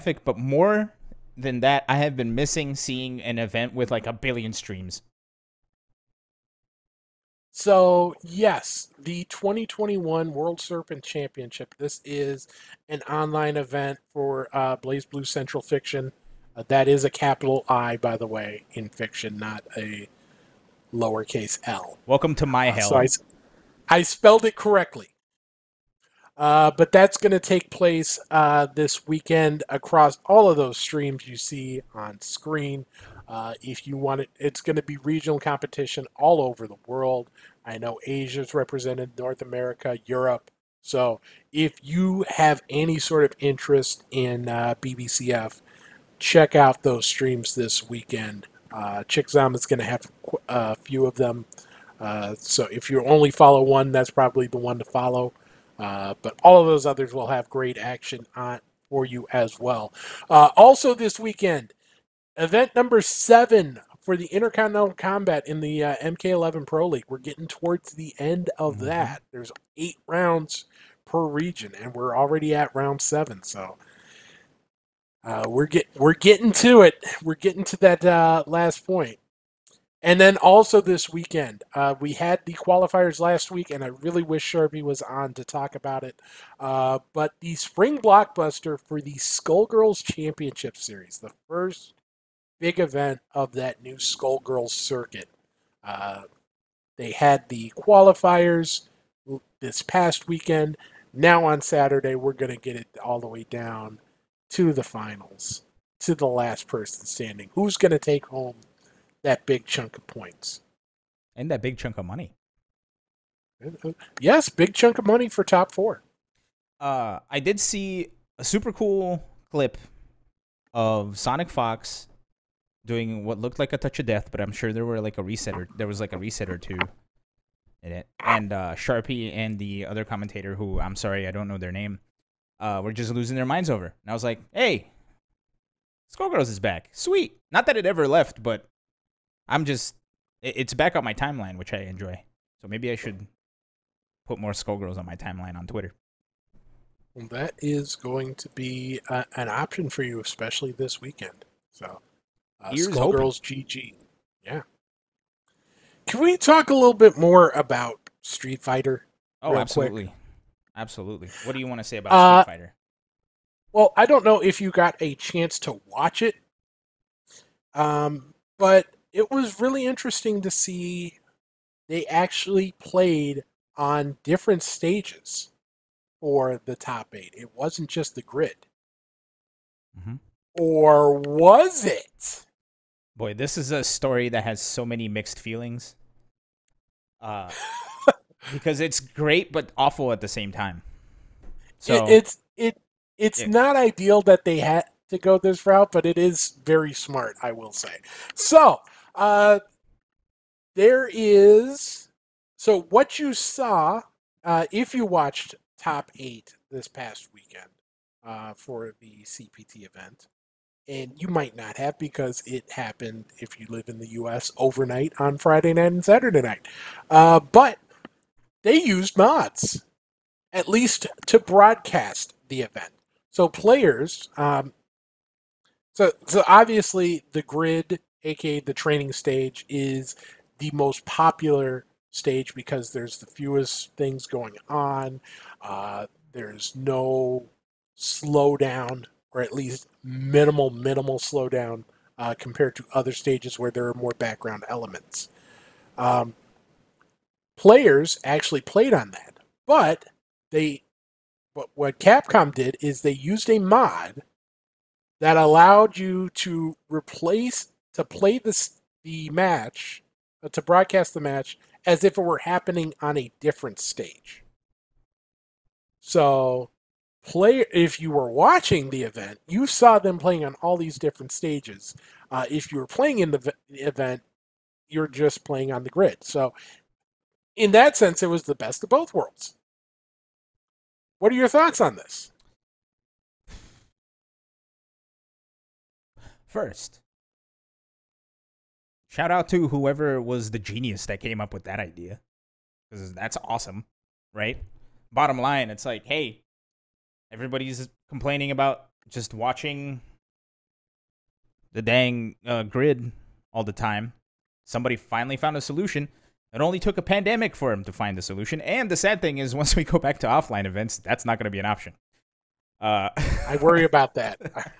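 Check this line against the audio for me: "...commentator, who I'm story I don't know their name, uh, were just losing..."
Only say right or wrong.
wrong.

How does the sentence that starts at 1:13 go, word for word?
So uh, we're get we're getting to it.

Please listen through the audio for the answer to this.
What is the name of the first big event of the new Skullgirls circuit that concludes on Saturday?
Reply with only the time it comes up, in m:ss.
1:27.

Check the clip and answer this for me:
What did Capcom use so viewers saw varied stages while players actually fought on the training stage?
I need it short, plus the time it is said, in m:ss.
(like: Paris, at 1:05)
a mod, at 4:13.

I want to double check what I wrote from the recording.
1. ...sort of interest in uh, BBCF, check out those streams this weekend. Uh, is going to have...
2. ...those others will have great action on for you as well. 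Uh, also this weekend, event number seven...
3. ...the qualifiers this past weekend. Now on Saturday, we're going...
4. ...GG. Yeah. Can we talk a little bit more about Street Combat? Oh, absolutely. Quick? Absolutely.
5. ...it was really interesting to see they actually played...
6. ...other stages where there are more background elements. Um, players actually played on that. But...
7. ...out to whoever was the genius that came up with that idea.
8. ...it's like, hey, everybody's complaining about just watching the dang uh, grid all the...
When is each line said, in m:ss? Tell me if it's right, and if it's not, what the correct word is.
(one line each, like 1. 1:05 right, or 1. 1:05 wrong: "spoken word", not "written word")
1. 0:42 right
2. 0:56 right
3. 1:37 right
4. 2:33 wrong: "Fighter", not "Combat"
5. 2:49 right
6. 4:02 right
7. 4:49 right
8. 4:55 right.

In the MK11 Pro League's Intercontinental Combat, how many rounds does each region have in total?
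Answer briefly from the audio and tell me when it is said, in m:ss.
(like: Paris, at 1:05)
8, at 1:09.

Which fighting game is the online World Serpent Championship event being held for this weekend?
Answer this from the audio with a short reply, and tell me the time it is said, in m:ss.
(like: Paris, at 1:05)
BlazBlue Central Fiction, at 0:14.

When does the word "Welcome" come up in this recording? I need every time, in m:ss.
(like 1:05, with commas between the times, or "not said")
0:22.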